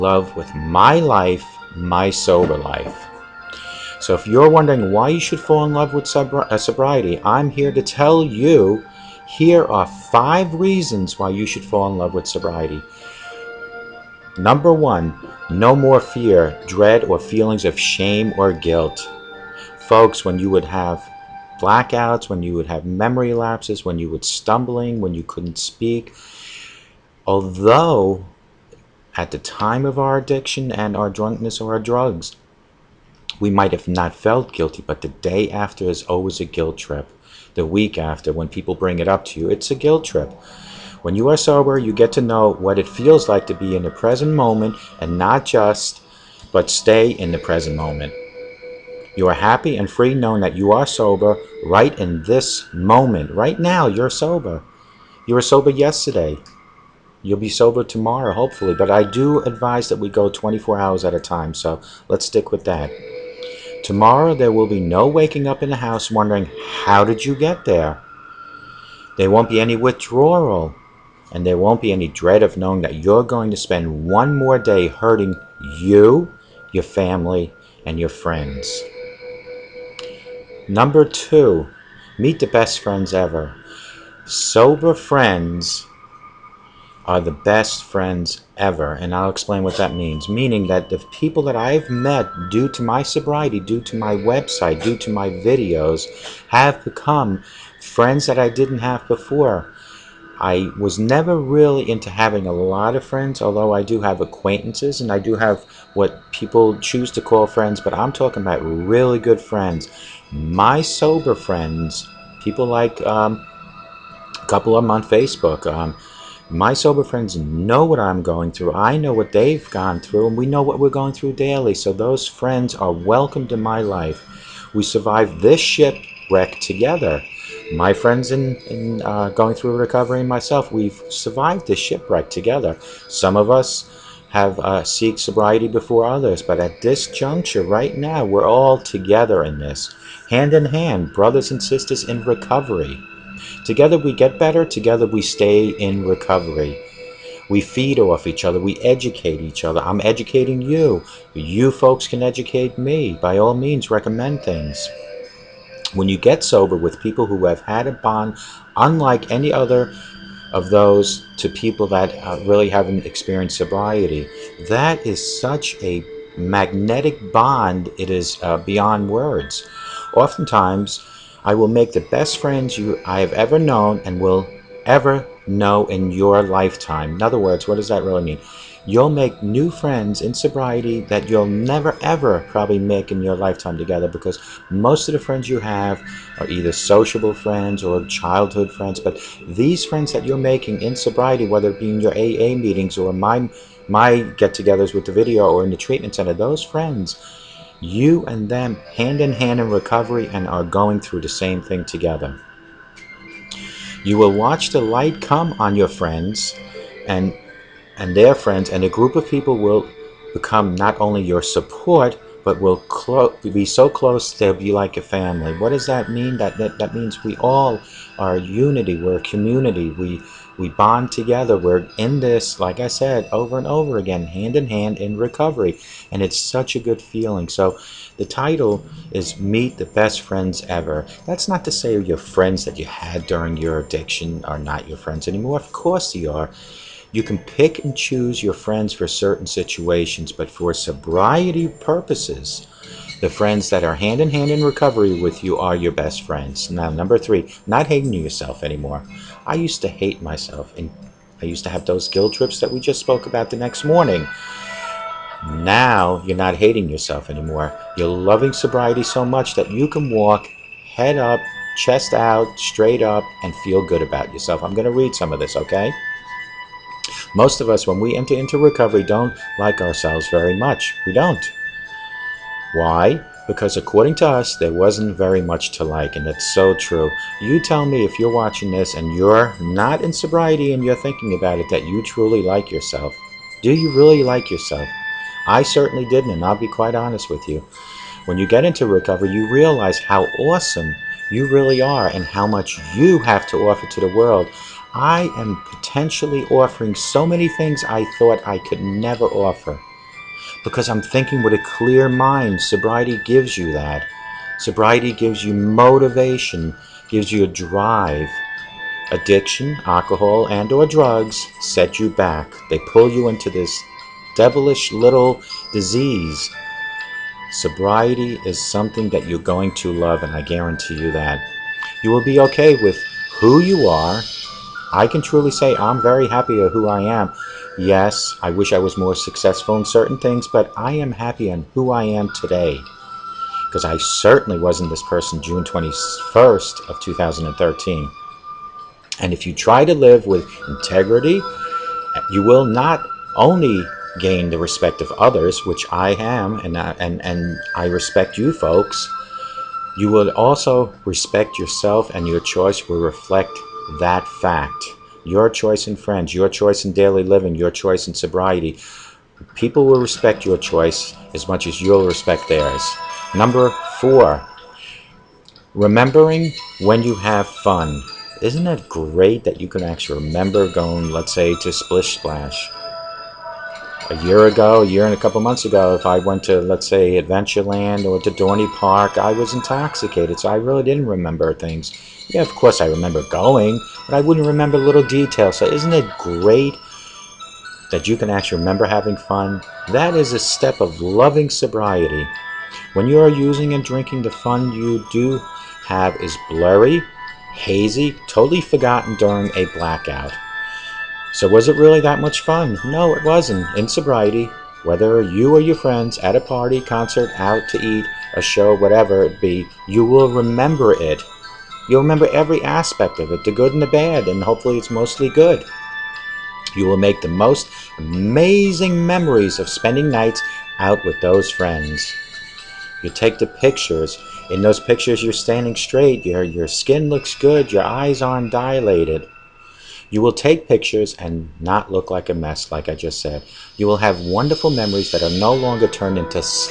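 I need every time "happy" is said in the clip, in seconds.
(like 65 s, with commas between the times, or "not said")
49 s, 326 s, 331 s.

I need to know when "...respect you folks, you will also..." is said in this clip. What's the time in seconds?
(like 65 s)
347 s.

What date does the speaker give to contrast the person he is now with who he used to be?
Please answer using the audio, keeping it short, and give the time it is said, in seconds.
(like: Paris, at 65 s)
June 21st of 2013, at 335 s.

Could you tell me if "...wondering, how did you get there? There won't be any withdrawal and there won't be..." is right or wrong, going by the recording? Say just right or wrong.
right.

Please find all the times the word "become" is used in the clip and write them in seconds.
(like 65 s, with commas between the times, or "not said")
96 s, 210 s.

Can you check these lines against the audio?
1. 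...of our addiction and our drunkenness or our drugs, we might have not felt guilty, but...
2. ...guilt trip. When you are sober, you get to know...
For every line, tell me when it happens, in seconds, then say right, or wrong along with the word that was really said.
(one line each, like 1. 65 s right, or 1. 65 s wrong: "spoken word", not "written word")
1. 29 s right
2. 39 s right.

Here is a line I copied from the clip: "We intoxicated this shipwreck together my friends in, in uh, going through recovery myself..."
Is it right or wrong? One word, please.
wrong.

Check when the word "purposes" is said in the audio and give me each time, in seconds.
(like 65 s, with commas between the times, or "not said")
241 s.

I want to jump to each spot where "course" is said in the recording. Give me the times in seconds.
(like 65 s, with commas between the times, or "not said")
235 s, 382 s.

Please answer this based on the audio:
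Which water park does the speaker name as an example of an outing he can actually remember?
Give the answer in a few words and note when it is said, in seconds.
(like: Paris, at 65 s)
Splish Splash, at 371 s.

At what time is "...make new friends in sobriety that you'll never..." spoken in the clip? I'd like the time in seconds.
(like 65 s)
179 s.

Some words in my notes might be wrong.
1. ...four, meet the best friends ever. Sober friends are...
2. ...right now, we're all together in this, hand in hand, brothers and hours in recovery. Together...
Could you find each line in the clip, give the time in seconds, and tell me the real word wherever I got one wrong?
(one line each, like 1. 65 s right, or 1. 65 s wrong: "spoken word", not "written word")
1. 81 s wrong: "two", not "four"
2. 137 s wrong: "sisters", not "hours".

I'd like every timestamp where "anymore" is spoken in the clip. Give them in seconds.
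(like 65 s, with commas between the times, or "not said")
235 s, 248 s, 257 s.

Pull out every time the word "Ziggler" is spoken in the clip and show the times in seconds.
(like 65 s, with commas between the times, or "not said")
not said.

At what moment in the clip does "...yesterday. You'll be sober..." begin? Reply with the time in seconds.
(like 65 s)
55 s.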